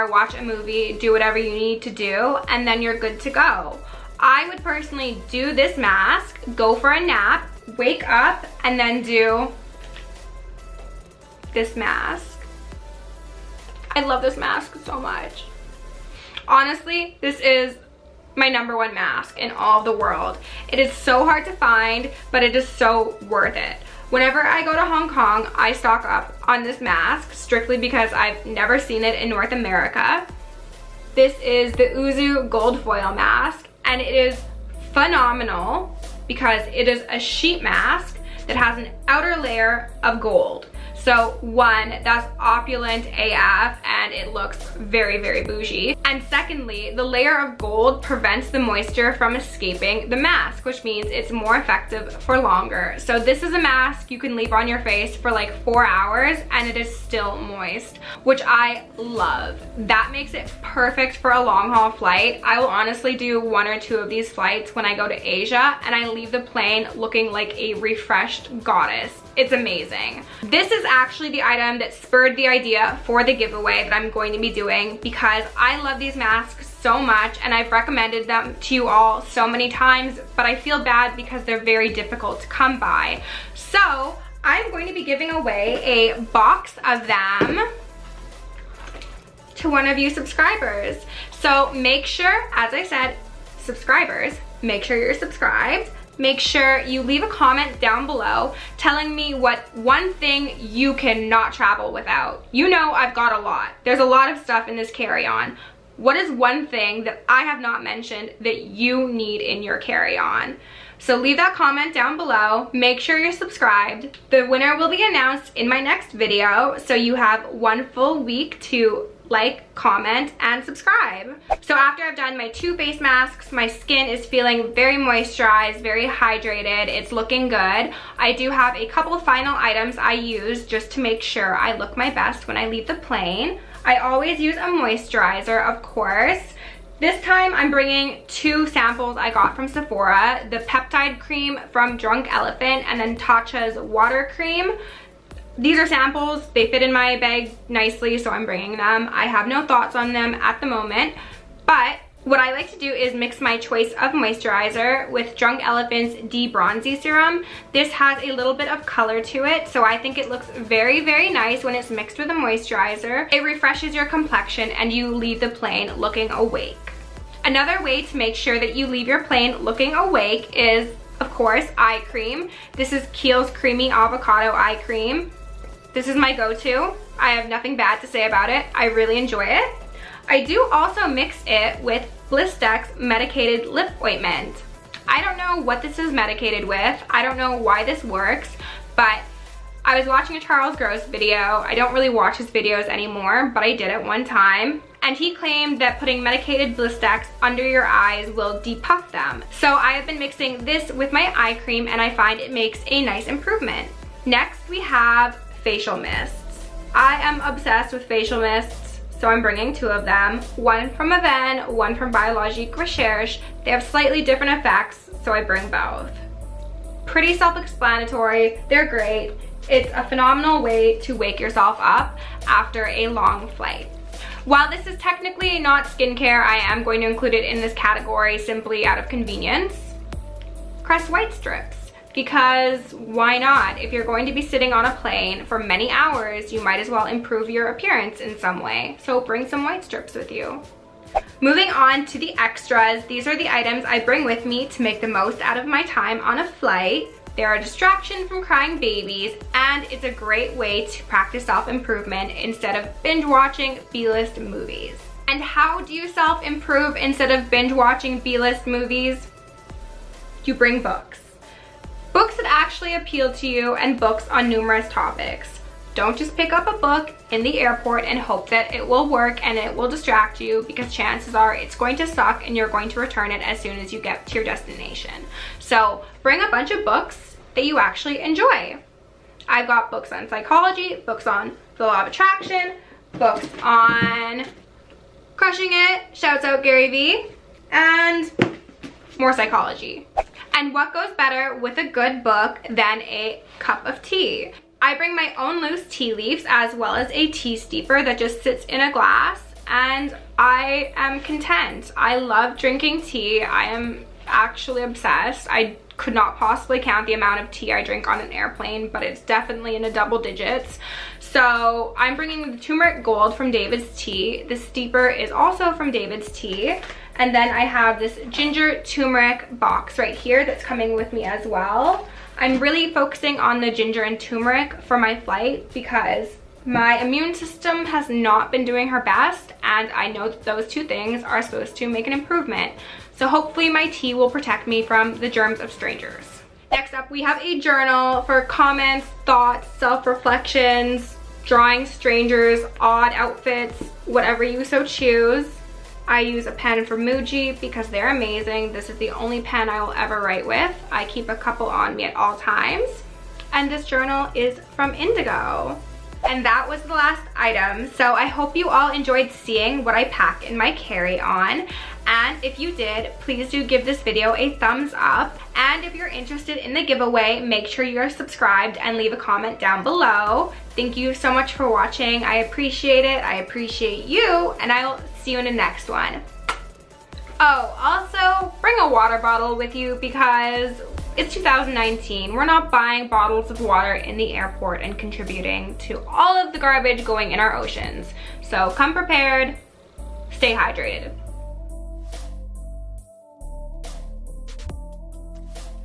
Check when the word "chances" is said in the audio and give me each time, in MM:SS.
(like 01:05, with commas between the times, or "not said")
04:30.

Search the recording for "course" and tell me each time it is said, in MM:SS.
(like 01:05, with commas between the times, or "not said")
02:15, 02:51.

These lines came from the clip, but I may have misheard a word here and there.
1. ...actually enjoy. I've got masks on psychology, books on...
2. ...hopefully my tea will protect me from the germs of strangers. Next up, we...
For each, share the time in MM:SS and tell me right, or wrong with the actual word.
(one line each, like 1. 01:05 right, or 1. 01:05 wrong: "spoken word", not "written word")
1. 04:37 wrong: "books", not "masks"
2. 05:33 right.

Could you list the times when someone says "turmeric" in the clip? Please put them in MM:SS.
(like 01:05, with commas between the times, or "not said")
05:12, 05:18, 05:24.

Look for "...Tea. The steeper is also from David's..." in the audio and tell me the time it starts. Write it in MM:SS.
05:13.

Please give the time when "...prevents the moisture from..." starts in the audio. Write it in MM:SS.
00:48.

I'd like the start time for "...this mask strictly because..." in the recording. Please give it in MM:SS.
00:26.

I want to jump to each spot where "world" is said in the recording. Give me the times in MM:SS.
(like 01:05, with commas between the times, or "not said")
00:19.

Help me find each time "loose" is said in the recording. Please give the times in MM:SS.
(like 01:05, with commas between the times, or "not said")
04:55.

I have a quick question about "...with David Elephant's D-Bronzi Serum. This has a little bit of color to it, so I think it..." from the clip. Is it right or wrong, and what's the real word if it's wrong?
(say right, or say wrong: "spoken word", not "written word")
wrong: "Drunk", not "David".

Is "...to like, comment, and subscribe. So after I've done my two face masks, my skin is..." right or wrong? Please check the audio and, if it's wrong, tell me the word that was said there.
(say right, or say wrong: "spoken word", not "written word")
right.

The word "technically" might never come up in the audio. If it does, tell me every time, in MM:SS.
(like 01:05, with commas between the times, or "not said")
03:44.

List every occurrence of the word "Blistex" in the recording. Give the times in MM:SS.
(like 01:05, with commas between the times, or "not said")
03:02, 03:16.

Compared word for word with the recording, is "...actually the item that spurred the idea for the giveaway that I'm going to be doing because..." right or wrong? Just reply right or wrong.
right.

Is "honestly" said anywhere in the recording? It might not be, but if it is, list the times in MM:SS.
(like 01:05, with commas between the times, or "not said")
00:16, 01:02.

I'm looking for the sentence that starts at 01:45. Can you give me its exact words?
What is one thing that I have not mentioned that you need in your carry-on?